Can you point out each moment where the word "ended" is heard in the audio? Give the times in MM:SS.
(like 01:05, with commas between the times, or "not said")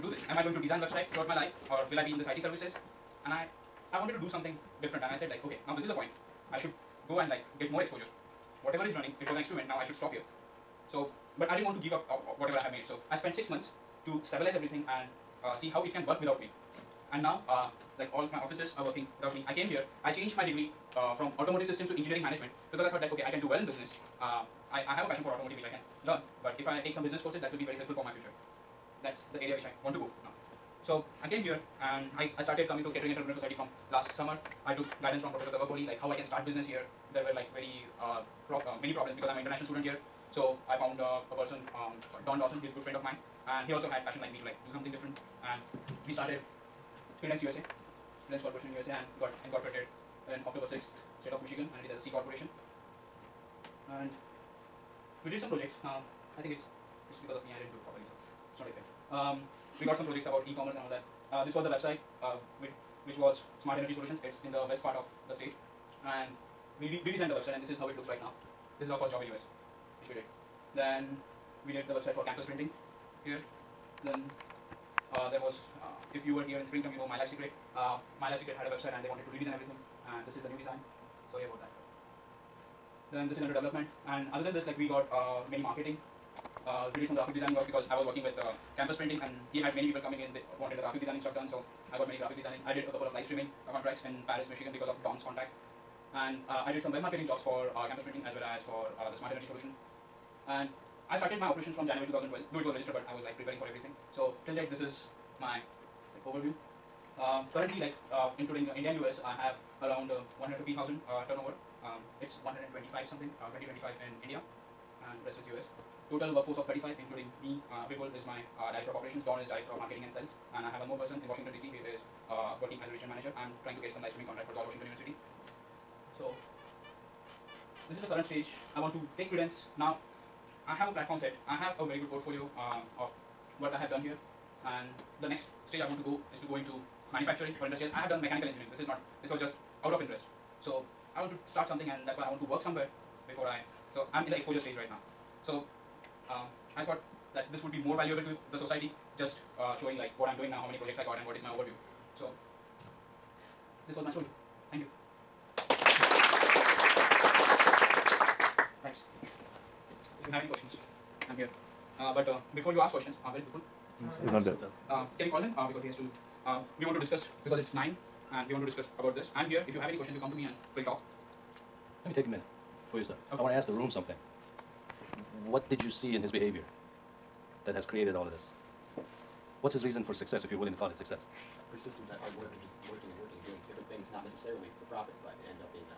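03:05.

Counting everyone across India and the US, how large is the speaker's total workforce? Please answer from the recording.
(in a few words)
35.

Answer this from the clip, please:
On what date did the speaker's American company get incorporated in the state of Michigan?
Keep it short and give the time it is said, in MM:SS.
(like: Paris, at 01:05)
October 6, at 00:50.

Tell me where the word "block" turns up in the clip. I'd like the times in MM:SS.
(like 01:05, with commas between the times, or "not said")
not said.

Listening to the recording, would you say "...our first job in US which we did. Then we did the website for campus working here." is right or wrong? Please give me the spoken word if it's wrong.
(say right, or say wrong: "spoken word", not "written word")
wrong: "printing", not "working".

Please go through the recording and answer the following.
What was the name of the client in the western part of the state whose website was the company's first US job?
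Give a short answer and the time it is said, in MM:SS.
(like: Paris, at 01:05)
Smart Energy Solutions, at 01:03.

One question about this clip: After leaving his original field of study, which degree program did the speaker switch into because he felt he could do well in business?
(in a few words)
engineering management.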